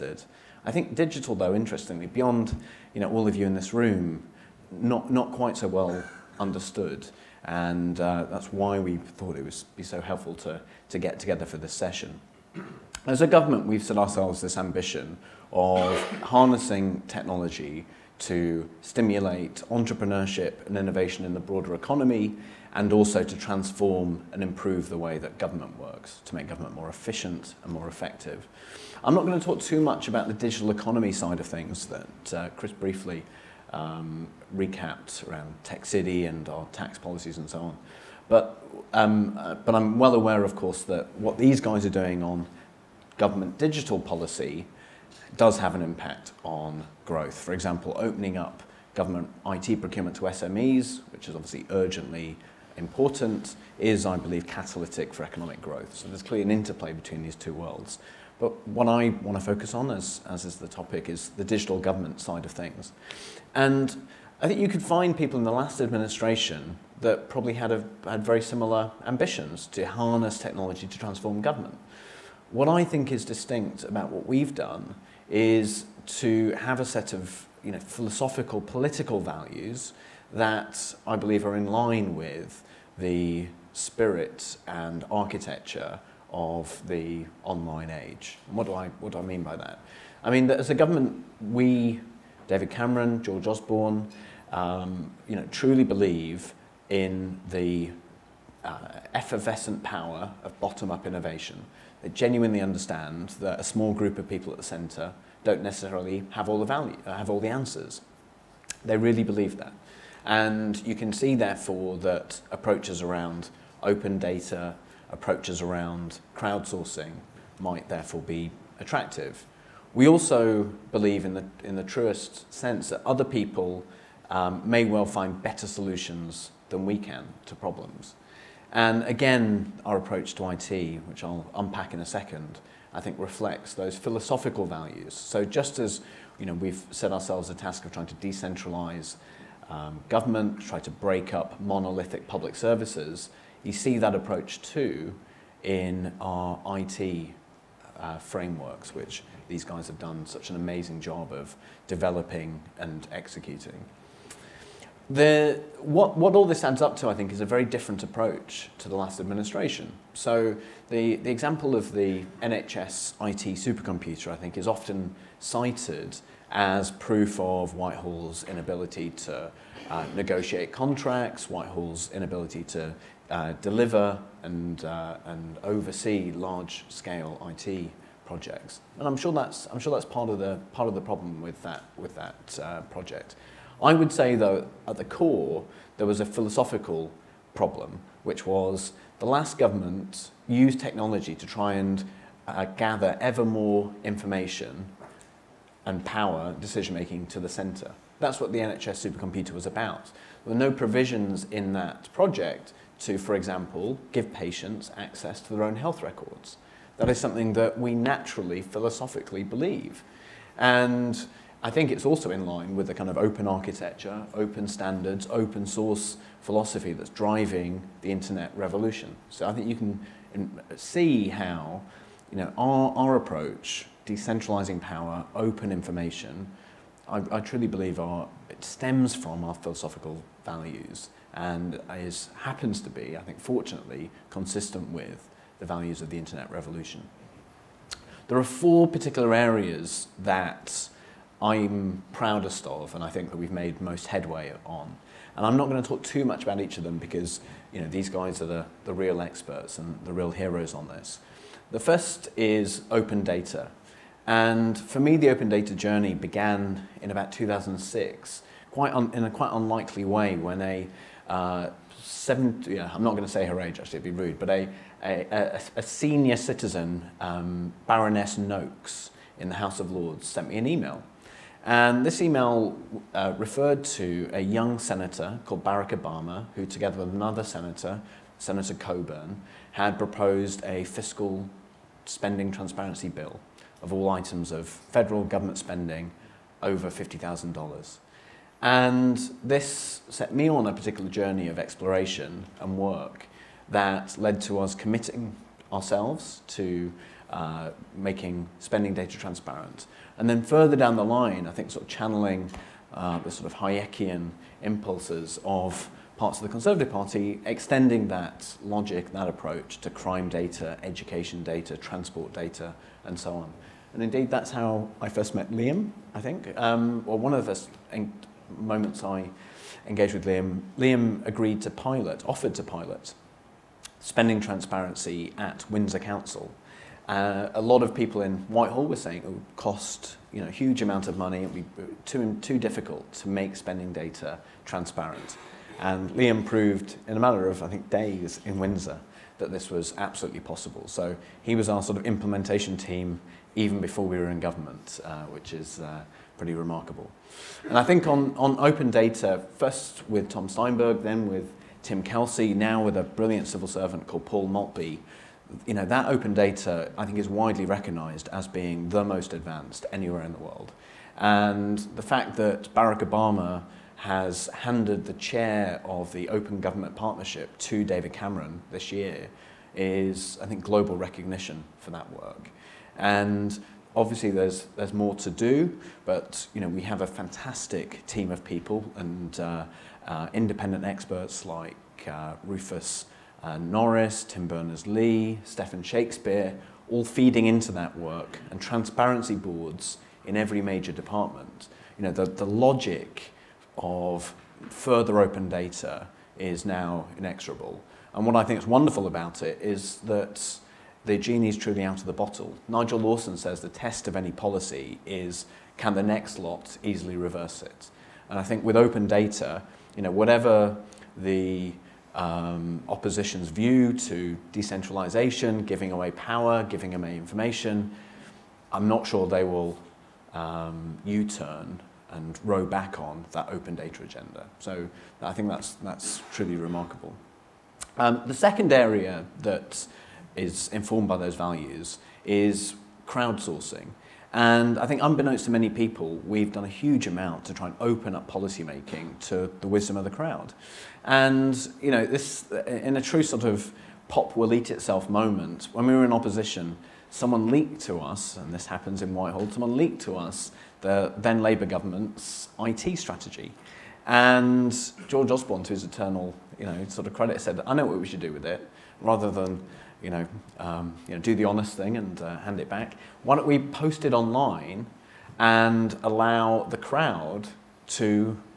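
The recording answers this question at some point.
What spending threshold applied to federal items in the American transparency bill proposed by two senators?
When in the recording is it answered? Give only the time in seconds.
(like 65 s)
286 s.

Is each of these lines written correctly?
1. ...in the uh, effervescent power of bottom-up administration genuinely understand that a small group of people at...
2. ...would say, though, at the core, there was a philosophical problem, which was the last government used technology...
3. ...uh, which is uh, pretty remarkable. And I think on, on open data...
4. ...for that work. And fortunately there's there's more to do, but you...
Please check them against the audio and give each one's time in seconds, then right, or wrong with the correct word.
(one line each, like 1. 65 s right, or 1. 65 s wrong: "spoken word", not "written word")
1. 96 s wrong: "innovation", not "administration"
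2. 183 s right
3. 345 s right
4. 371 s wrong: "obviously", not "fortunately".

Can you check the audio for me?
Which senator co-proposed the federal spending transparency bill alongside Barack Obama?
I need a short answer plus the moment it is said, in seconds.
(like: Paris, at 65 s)
Senator Coburn, at 278 s.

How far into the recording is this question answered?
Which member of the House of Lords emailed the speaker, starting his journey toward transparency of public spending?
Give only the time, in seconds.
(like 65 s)
267 s.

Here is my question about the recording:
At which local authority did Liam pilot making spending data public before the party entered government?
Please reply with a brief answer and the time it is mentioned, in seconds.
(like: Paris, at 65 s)
Windsor Council, at 325 s.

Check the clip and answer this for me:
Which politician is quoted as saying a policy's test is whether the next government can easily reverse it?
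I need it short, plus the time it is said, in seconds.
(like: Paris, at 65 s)
Nigel Lawson, at 402 s.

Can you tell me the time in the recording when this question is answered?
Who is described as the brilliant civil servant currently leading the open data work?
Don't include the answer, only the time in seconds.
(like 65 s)
354 s.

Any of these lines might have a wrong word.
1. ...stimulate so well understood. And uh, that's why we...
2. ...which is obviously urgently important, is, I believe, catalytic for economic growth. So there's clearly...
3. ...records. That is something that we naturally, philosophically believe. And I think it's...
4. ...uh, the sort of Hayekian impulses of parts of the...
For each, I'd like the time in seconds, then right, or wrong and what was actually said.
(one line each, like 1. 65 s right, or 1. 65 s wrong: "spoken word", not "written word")
1. 5 s wrong: "quite", not "stimulate"
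2. 51 s right
3. 206 s right
4. 302 s right.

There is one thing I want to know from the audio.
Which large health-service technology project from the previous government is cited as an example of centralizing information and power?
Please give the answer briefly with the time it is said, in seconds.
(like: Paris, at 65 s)
NHS IT supercomputer, at 162 s.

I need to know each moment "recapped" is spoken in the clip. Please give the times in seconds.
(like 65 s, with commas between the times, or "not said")
34 s.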